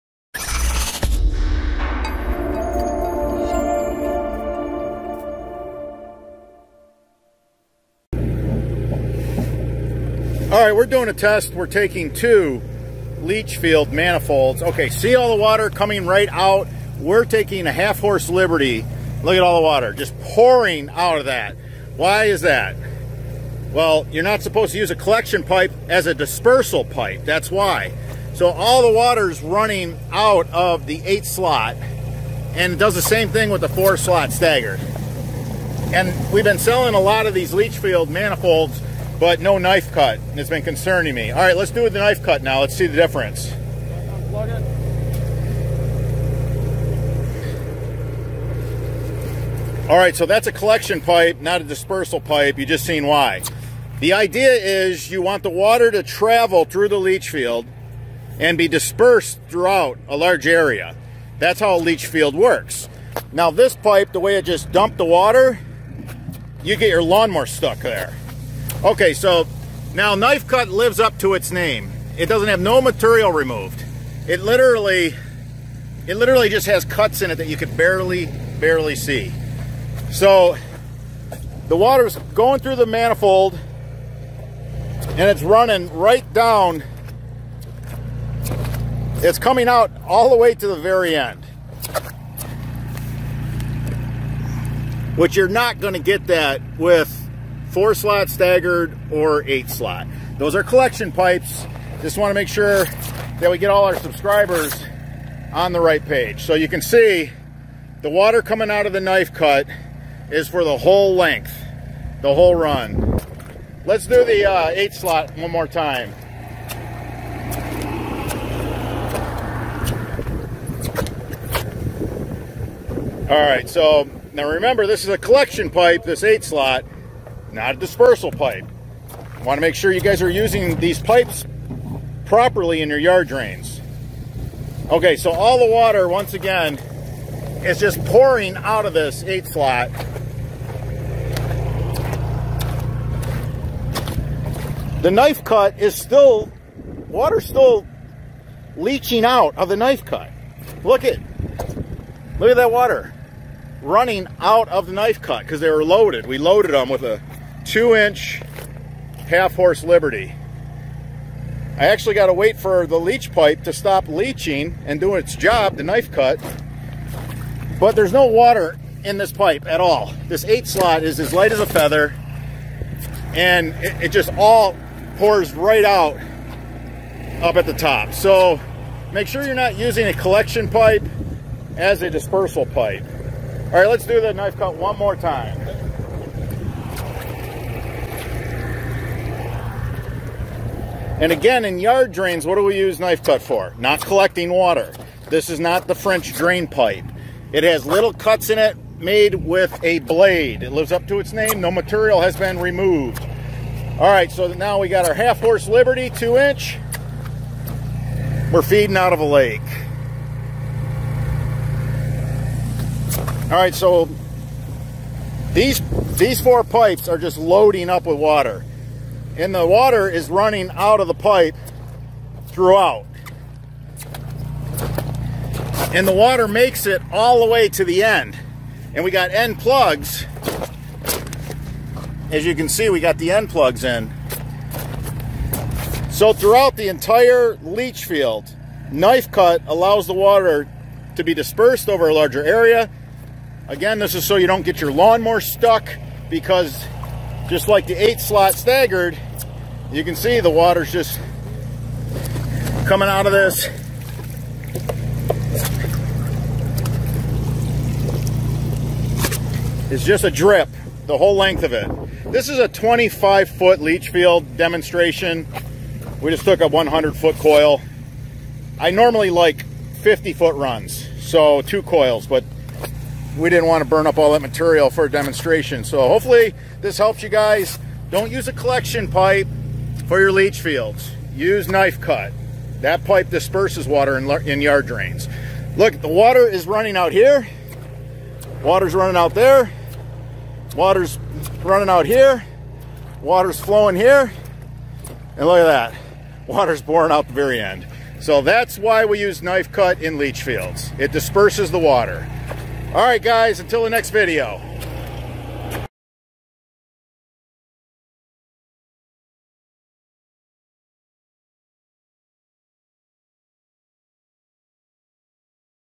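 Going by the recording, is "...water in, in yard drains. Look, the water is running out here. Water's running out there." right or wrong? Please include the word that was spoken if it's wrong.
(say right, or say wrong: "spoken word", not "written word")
right.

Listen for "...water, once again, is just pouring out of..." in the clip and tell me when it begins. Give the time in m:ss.
2:15.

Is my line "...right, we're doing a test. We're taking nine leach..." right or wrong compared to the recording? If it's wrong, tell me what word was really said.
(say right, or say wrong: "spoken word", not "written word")
wrong: "two", not "nine".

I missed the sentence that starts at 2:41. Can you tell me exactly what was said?
I actually got to wait for the leach pipe to stop leaching and do its job, the knife cut.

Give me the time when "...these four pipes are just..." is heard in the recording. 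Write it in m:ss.
3:36.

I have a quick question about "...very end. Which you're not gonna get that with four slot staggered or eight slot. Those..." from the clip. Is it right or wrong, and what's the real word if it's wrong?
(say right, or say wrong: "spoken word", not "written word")
right.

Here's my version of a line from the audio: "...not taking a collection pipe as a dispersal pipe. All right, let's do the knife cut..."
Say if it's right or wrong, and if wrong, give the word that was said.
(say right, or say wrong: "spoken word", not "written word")
wrong: "using", not "taking".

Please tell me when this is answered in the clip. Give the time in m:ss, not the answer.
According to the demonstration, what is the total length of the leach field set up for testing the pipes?
4:22.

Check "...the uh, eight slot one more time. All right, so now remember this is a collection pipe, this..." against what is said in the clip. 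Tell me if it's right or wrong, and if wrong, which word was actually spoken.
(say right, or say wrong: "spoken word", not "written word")
right.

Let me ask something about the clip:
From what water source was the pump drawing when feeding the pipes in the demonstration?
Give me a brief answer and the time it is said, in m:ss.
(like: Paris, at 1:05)
a lake, at 3:28.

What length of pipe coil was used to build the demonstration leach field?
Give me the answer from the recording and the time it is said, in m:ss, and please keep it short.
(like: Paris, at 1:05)
100 feet, at 4:26.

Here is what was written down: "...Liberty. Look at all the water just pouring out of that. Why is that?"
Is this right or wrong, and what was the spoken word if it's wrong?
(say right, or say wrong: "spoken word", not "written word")
right.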